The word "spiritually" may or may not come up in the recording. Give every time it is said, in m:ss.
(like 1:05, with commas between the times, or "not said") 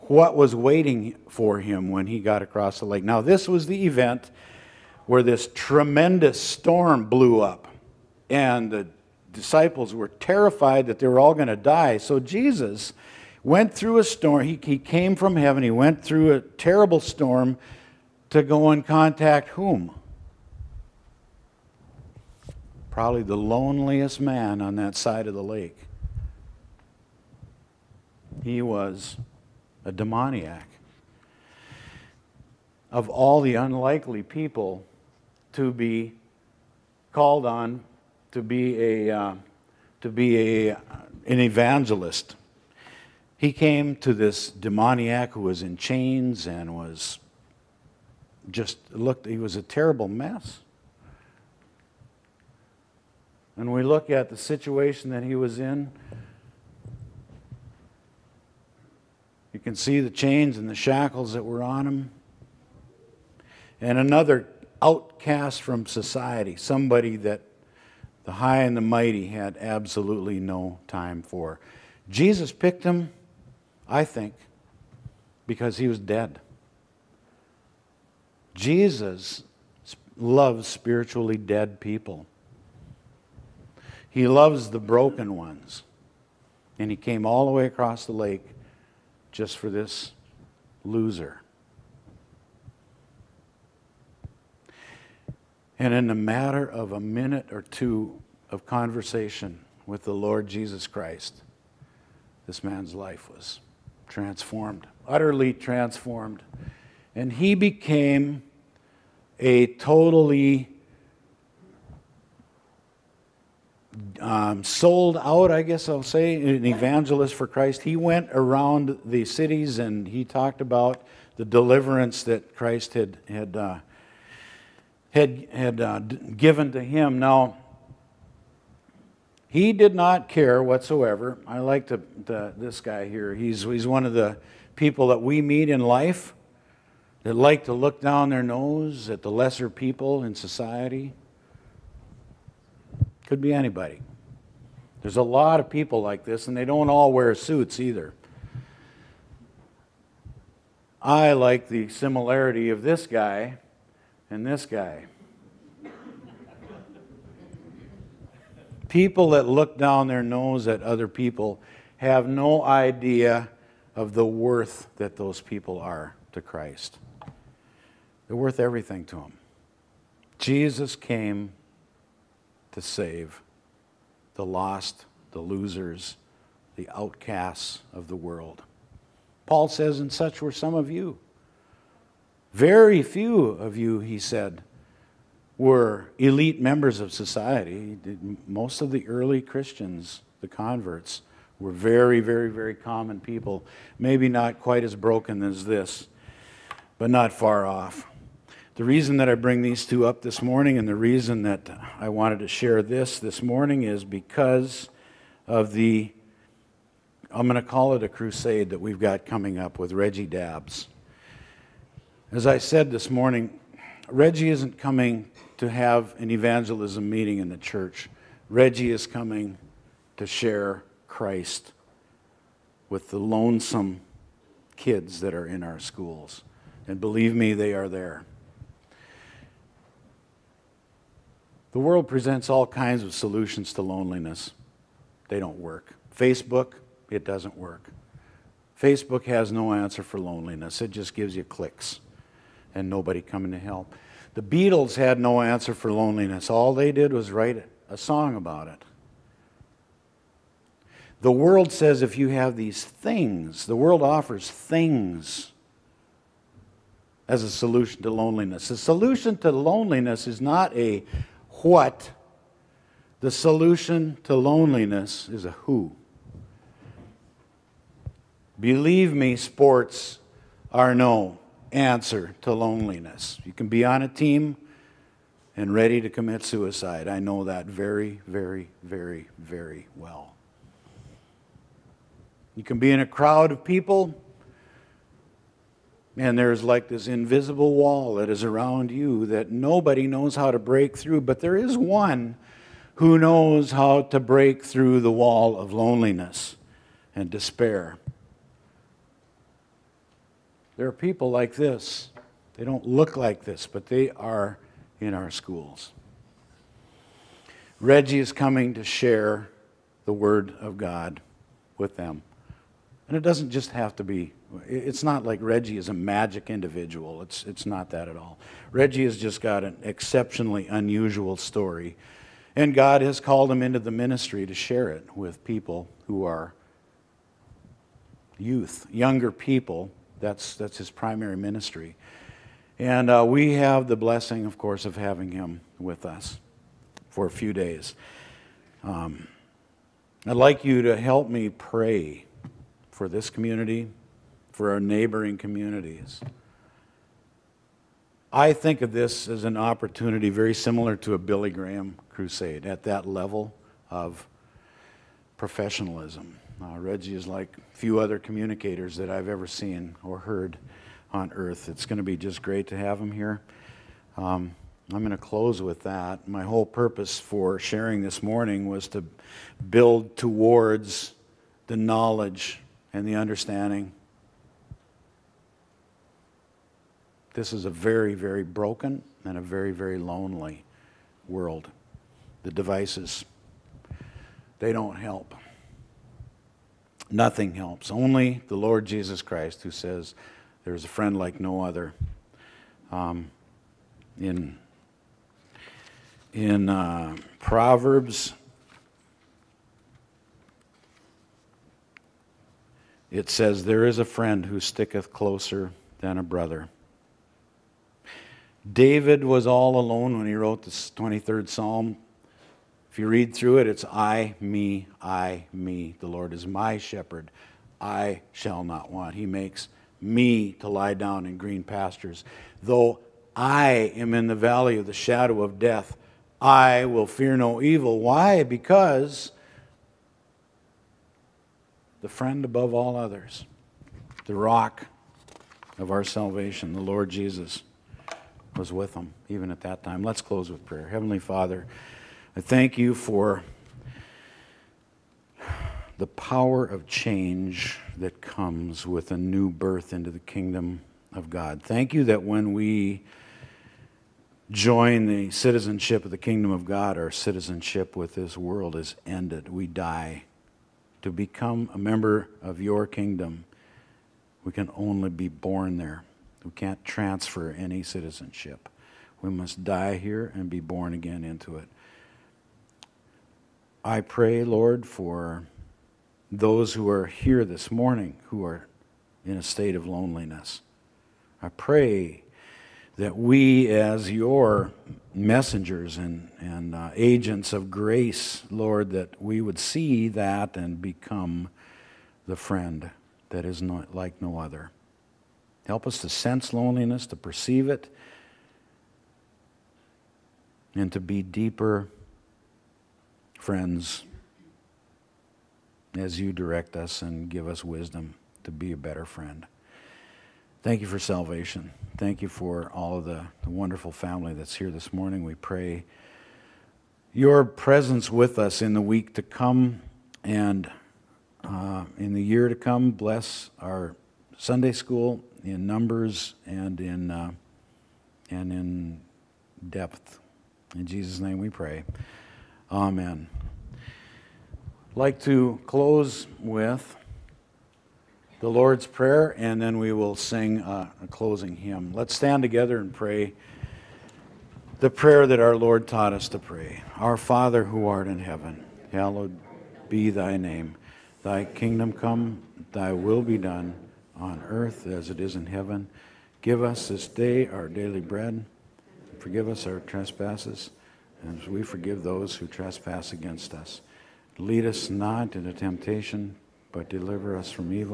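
1:20.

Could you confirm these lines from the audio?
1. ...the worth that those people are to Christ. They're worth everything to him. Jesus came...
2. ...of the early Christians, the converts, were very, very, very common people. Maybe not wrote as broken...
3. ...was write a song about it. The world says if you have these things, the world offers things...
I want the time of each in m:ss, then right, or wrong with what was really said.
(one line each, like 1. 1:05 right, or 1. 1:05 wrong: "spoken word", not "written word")
1. 2:44 right
2. 3:08 wrong: "quite", not "wrote"
3. 4:07 right.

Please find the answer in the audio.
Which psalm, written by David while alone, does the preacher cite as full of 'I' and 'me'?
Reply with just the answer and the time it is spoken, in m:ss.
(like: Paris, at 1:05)
23rd Psalm, at 6:50.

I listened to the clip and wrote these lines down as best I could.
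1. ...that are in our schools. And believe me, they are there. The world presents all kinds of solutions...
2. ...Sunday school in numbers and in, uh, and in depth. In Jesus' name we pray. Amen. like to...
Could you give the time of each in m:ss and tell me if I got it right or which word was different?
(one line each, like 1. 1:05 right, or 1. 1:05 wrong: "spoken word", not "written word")
1. 3:45 right
2. 8:44 right.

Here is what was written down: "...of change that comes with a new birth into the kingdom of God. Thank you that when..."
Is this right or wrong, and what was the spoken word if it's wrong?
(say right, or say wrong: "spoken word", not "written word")
right.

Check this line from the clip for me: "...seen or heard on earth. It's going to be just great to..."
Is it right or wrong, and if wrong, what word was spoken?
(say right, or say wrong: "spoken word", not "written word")
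right.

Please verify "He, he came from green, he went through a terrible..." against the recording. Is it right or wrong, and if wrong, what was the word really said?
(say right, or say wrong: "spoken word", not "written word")
wrong: "heaven", not "green".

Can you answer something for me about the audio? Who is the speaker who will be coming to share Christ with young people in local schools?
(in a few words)
Reggie Dabbs.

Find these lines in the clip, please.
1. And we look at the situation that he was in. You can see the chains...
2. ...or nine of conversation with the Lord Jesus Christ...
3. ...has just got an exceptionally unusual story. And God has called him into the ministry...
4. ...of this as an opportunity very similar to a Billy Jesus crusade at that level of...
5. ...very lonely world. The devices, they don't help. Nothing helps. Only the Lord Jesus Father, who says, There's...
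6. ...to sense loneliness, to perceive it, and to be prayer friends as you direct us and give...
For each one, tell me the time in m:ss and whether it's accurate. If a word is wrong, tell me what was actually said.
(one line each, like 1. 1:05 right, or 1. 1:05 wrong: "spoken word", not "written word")
1. 0:53 right
2. 1:37 wrong: "two", not "nine"
3. 5:19 right
4. 5:48 wrong: "Graham", not "Jesus"
5. 6:19 wrong: "Christ", not "Father"
6. 8:15 wrong: "deeper", not "prayer".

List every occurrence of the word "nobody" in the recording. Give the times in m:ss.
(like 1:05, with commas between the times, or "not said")
4:02, 4:49.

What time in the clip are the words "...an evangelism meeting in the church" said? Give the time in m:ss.
3:36.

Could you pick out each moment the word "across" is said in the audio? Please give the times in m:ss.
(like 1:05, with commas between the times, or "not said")
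0:02, 1:27.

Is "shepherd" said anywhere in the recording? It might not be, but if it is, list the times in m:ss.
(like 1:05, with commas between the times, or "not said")
6:56.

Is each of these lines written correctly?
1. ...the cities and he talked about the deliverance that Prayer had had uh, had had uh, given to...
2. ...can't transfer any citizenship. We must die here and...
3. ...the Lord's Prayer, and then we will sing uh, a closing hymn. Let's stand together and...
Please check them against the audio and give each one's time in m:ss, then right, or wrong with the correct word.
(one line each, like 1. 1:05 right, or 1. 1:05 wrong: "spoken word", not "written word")
1. 1:59 wrong: "Christ", not "Prayer"
2. 7:46 right
3. 8:58 right.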